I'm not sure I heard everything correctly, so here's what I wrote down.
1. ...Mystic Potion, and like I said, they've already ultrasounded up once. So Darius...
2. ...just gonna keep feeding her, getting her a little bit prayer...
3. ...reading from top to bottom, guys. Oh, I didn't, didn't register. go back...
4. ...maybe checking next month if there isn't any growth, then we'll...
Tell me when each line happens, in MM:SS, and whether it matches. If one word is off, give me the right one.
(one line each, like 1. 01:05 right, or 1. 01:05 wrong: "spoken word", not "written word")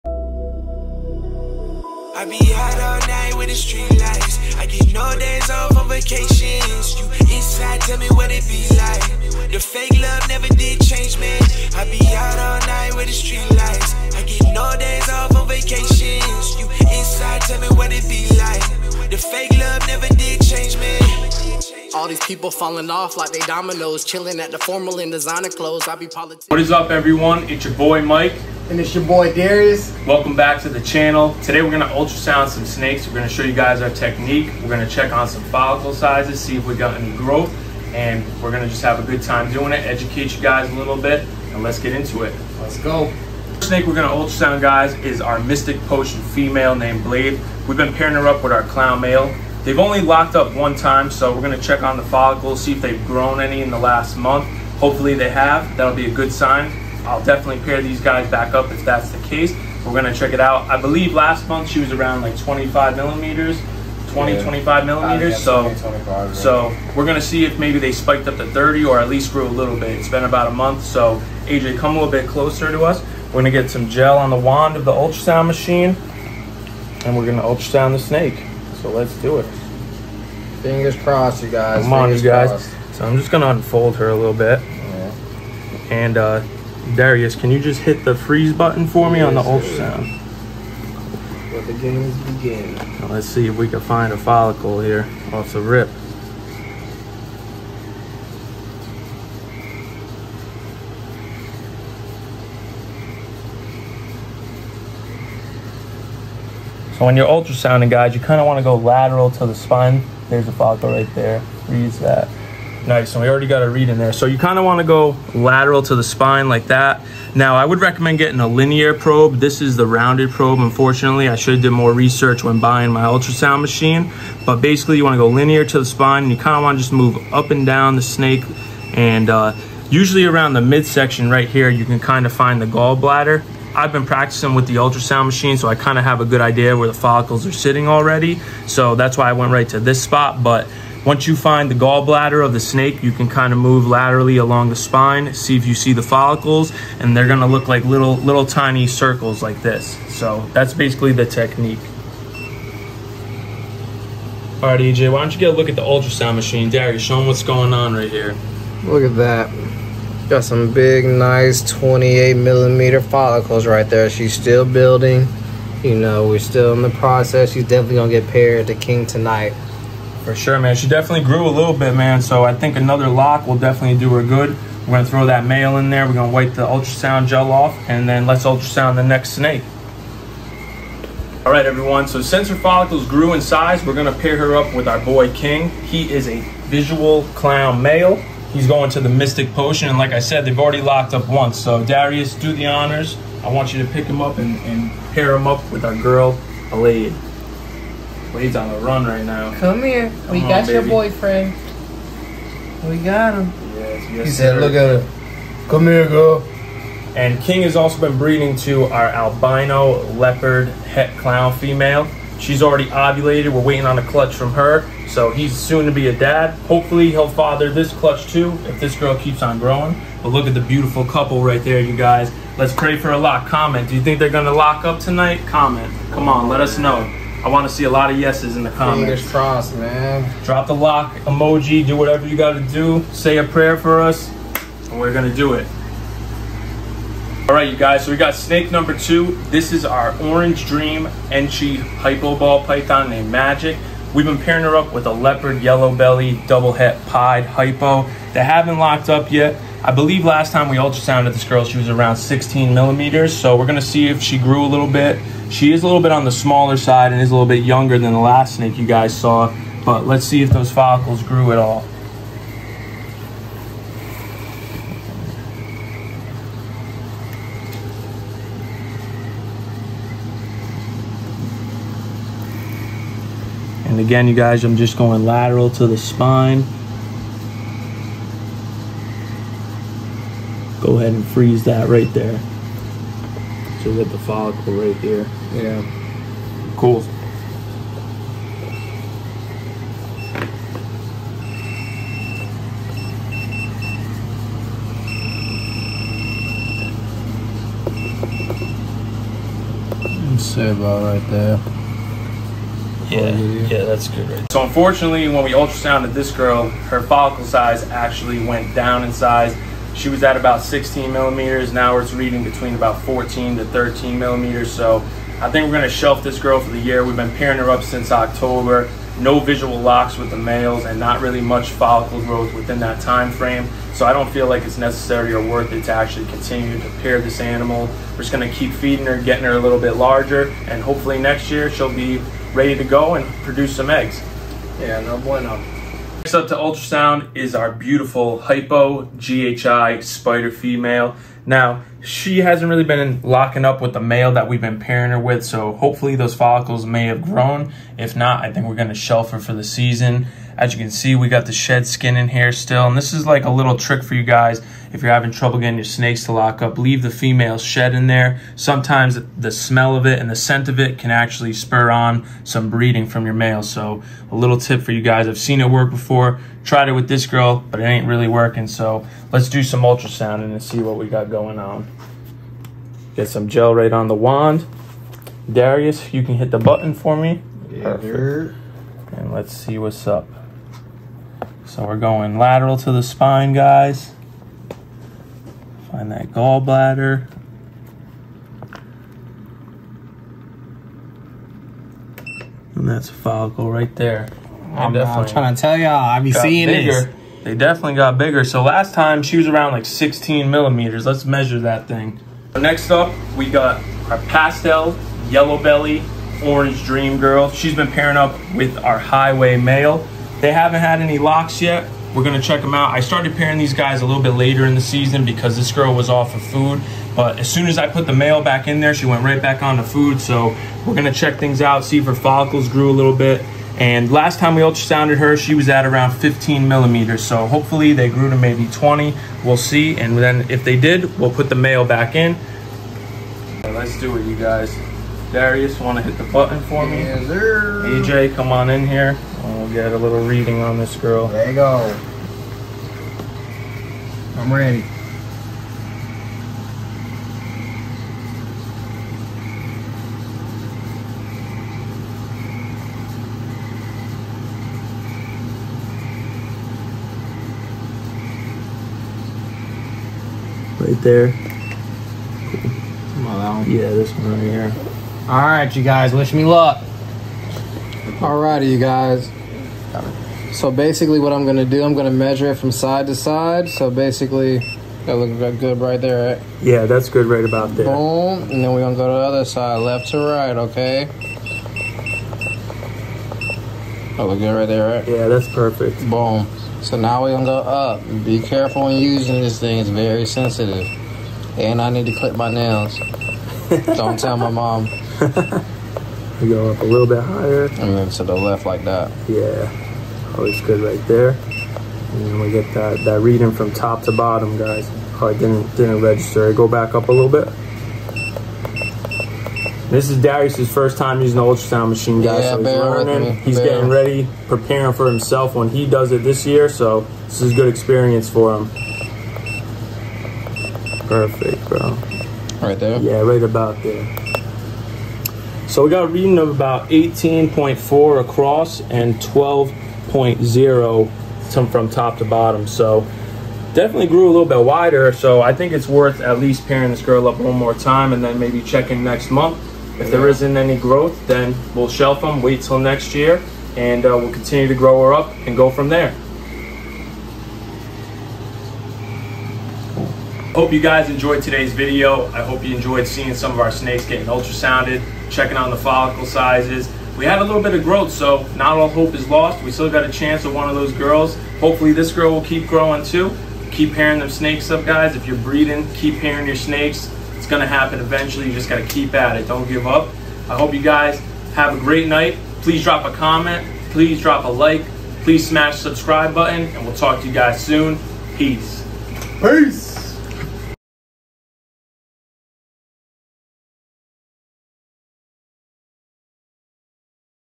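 1. 03:09 wrong: "locked", not "ultrasounded"
2. 05:28 wrong: "larger", not "prayer"
3. 08:23 right
4. 08:58 right.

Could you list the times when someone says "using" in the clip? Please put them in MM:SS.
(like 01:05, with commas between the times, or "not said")
08:08, 08:31.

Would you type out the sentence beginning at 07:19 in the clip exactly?
We'll get a little reading on this girl.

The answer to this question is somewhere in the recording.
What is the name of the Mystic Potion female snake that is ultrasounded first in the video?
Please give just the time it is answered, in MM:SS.
00:47.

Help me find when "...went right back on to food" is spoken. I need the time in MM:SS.
06:59.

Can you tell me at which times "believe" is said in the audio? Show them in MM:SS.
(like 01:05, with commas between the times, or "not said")
01:00, 04:09.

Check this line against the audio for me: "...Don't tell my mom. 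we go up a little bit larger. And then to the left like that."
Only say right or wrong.
wrong.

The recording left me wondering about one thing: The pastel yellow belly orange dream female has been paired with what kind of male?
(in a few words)
highway male.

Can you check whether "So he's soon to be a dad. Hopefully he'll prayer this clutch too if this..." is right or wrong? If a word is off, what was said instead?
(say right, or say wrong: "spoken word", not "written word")
wrong: "father", not "prayer".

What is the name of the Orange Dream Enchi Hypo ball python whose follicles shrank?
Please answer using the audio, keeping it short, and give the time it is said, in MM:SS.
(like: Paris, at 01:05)
Magic, at 04:03.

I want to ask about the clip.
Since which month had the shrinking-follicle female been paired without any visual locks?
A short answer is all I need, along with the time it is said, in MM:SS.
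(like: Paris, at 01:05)
October, at 05:18.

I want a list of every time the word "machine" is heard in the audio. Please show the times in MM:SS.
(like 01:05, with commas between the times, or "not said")
01:15, 02:03, 02:15, 02:36, 08:31.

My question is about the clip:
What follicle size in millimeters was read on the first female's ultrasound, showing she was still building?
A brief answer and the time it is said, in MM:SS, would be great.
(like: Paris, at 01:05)
28 millimeters, at 02:41.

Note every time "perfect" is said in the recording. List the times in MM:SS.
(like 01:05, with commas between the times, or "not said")
06:17, 08:05, 08:41.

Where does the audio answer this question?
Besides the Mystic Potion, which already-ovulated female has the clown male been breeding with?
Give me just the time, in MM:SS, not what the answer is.
03:29.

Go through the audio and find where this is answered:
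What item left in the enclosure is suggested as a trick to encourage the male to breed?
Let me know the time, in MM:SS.
05:57.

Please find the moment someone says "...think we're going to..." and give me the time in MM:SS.
05:48.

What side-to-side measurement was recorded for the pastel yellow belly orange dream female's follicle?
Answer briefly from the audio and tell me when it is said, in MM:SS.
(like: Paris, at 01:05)
18.4, at 08:46.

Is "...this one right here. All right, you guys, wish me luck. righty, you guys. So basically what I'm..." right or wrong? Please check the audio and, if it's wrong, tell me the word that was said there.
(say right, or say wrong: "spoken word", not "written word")
right.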